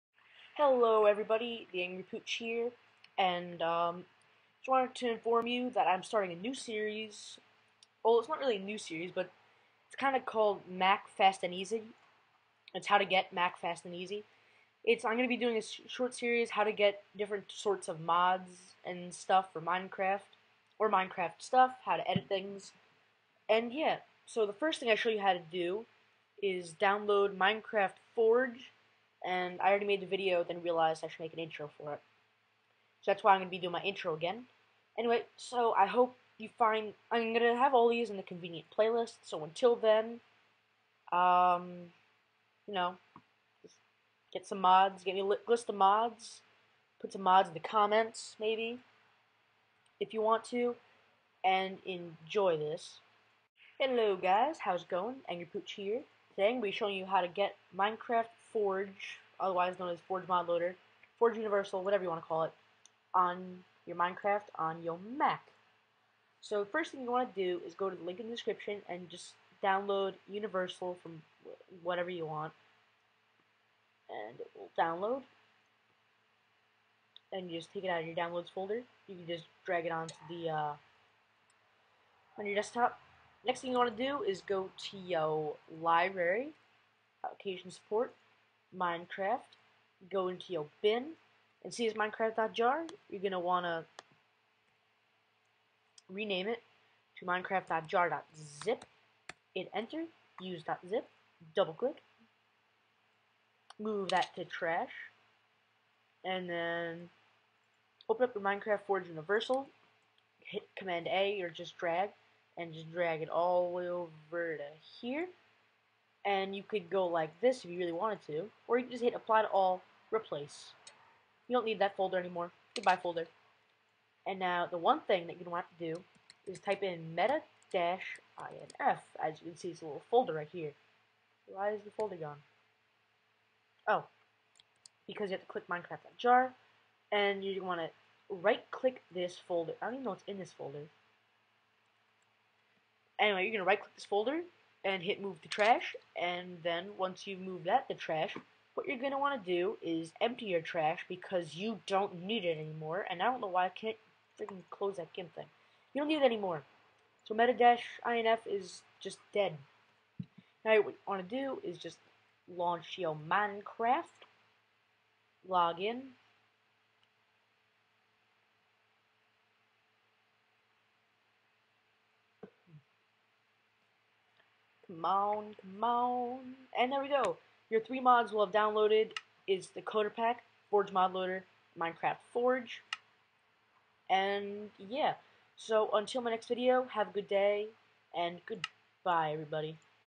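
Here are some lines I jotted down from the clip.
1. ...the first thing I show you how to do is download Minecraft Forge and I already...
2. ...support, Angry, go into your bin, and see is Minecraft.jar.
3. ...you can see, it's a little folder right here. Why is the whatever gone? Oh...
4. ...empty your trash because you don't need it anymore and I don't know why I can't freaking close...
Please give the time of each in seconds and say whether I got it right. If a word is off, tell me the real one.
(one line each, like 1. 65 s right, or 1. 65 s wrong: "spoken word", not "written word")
1. 24 s right
2. 87 s wrong: "Minecraft", not "Angry"
3. 129 s wrong: "folder", not "whatever"
4. 150 s right.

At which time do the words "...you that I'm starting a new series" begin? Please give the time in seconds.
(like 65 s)
5 s.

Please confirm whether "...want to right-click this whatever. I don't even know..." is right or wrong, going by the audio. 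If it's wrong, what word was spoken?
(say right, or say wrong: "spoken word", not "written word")
wrong: "folder", not "whatever".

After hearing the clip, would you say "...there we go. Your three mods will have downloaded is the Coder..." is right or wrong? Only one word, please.
right.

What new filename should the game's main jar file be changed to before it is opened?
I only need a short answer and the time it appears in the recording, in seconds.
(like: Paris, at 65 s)
Minecraft.jar.zip, at 97 s.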